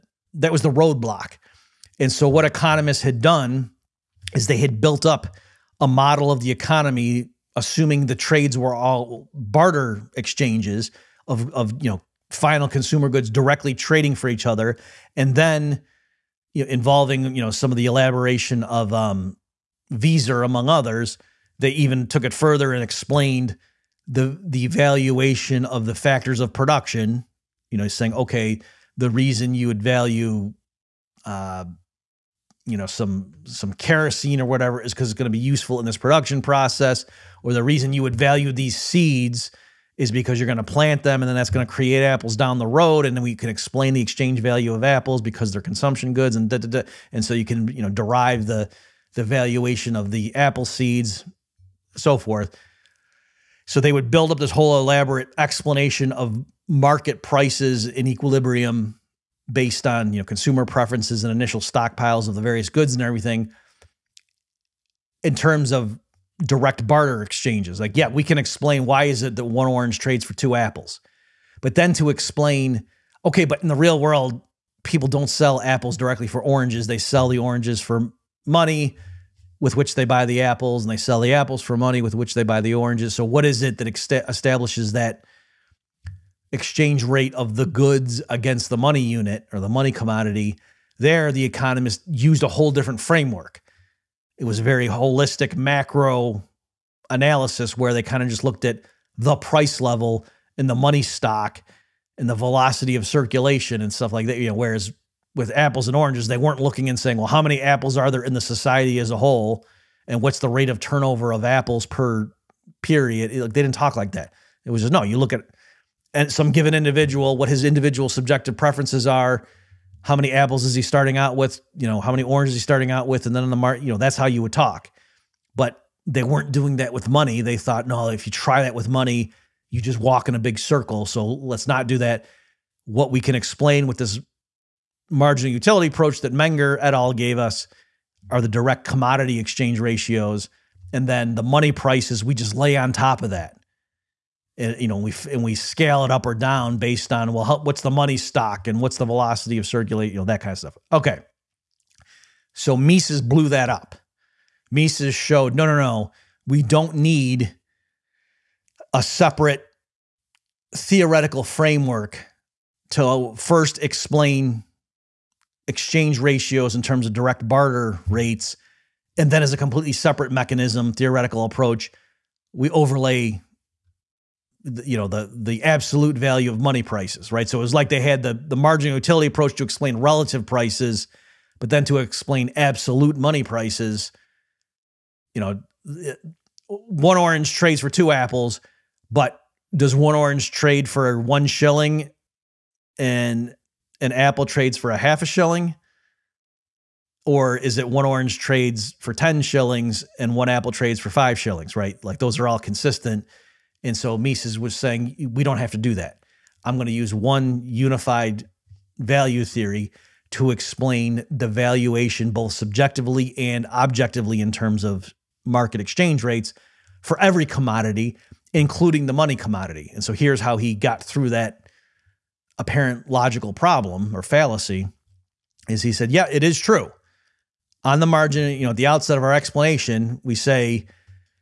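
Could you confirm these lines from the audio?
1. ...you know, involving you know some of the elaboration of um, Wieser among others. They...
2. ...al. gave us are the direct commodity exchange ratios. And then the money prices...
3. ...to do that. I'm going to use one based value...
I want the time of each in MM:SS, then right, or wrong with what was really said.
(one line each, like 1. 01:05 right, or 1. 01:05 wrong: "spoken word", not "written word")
1. 00:16 right
2. 02:16 right
3. 03:25 wrong: "unified", not "based".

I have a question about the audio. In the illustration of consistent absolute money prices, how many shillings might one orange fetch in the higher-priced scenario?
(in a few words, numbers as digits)
10 shillings.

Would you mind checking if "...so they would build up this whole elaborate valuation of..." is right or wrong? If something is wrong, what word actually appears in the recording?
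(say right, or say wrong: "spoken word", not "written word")
wrong: "explanation", not "valuation".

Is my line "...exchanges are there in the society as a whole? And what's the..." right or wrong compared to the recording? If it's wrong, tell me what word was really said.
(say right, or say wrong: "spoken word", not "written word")
wrong: "apples", not "exchanges".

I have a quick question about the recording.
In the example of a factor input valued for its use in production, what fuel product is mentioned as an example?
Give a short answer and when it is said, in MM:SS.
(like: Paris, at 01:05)
Kerosene, at 00:33.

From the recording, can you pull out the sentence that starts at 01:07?
Like, yeah, we can explain why is it that one orange trades for two apples.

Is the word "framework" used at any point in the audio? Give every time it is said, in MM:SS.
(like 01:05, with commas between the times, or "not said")
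01:33, 02:41.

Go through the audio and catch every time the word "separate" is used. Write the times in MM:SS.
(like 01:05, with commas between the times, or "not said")
02:39, 02:49.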